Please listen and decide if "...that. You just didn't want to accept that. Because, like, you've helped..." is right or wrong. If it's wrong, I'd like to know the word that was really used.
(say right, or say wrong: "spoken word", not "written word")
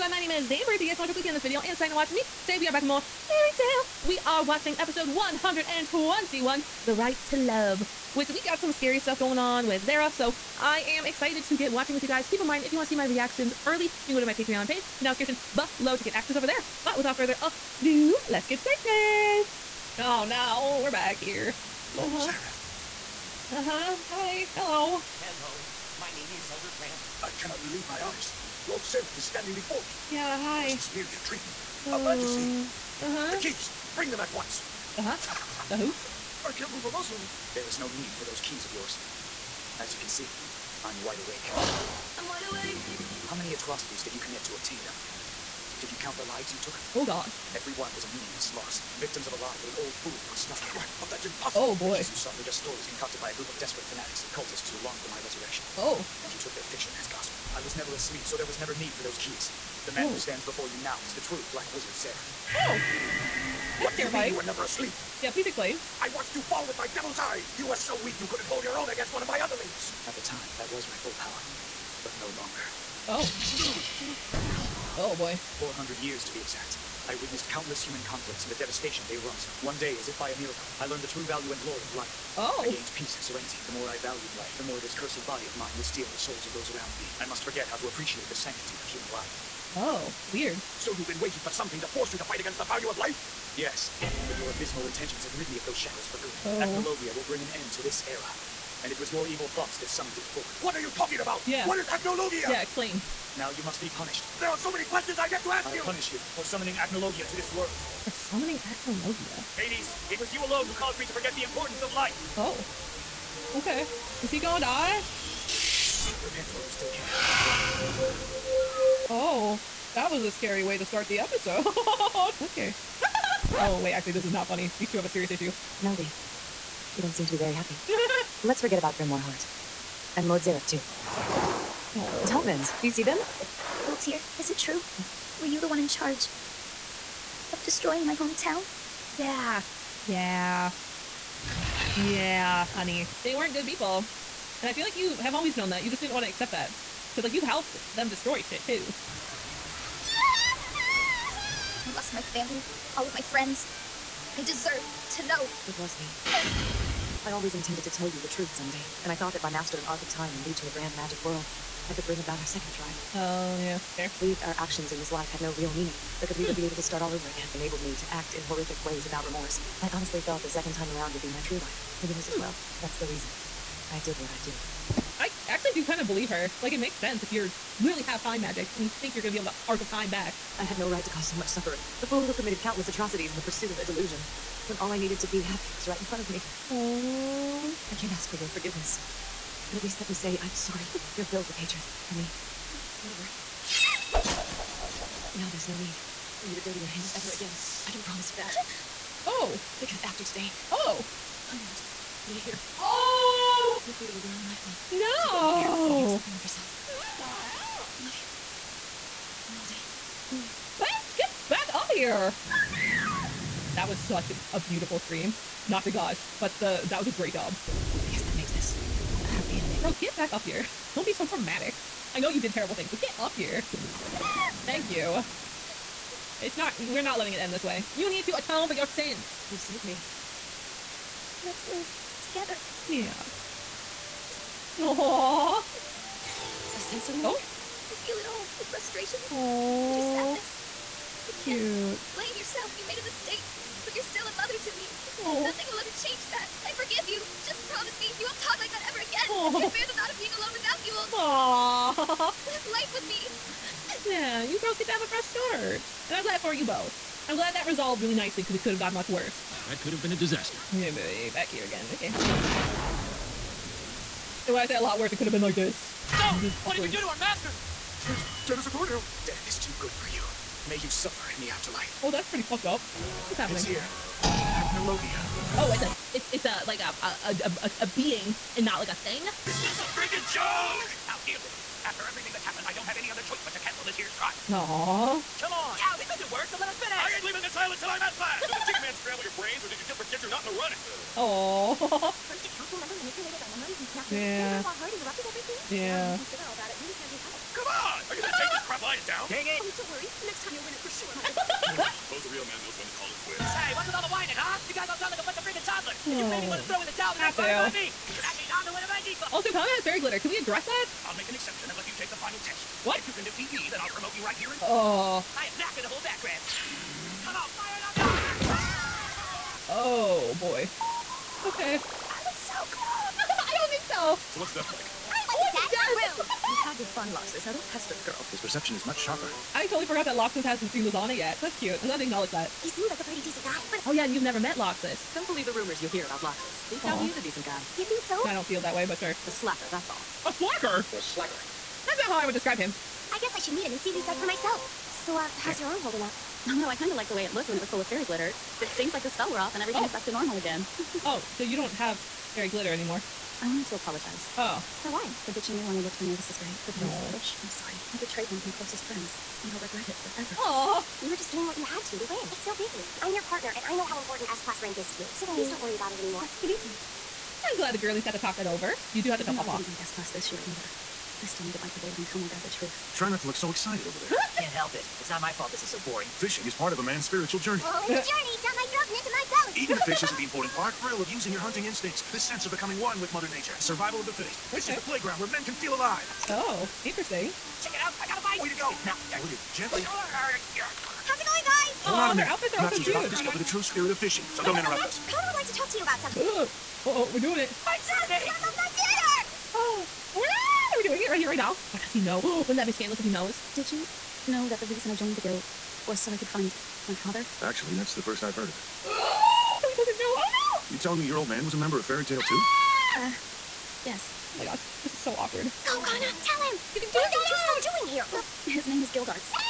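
right.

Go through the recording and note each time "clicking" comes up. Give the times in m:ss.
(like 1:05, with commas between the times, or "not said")
0:01.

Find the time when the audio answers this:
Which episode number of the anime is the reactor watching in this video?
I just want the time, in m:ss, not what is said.
0:04.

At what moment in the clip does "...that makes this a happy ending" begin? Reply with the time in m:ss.
3:38.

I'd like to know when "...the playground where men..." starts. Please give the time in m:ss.
6:24.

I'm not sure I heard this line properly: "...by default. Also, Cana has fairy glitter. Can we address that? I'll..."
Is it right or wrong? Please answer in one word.
right.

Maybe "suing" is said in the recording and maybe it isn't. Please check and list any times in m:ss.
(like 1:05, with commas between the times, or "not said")
not said.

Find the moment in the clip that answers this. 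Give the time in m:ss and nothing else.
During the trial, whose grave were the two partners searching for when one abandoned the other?
5:56.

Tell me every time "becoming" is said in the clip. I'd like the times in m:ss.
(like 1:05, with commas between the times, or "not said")
6:22.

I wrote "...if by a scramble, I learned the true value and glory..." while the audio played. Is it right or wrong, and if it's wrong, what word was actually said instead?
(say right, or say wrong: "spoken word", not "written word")
wrong: "miracle", not "scramble".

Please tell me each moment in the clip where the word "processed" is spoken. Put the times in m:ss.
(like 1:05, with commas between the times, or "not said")
not said.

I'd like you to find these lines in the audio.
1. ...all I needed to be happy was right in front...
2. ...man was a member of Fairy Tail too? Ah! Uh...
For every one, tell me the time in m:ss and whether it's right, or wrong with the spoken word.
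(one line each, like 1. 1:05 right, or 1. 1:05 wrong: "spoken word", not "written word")
1. 3:04 right
2. 6:51 right.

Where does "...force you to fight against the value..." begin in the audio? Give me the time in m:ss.
1:31.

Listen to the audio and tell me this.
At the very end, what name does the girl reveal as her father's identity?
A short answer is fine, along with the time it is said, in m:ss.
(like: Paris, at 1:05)
Gildarts, at 6:58.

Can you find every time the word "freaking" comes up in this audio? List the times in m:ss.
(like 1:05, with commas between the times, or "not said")
4:39, 5:05.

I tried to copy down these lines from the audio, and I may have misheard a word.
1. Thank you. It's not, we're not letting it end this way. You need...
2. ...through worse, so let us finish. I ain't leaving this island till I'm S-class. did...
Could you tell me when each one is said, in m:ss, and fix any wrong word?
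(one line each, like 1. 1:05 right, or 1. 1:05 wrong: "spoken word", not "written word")
1. 3:44 right
2. 4:46 right.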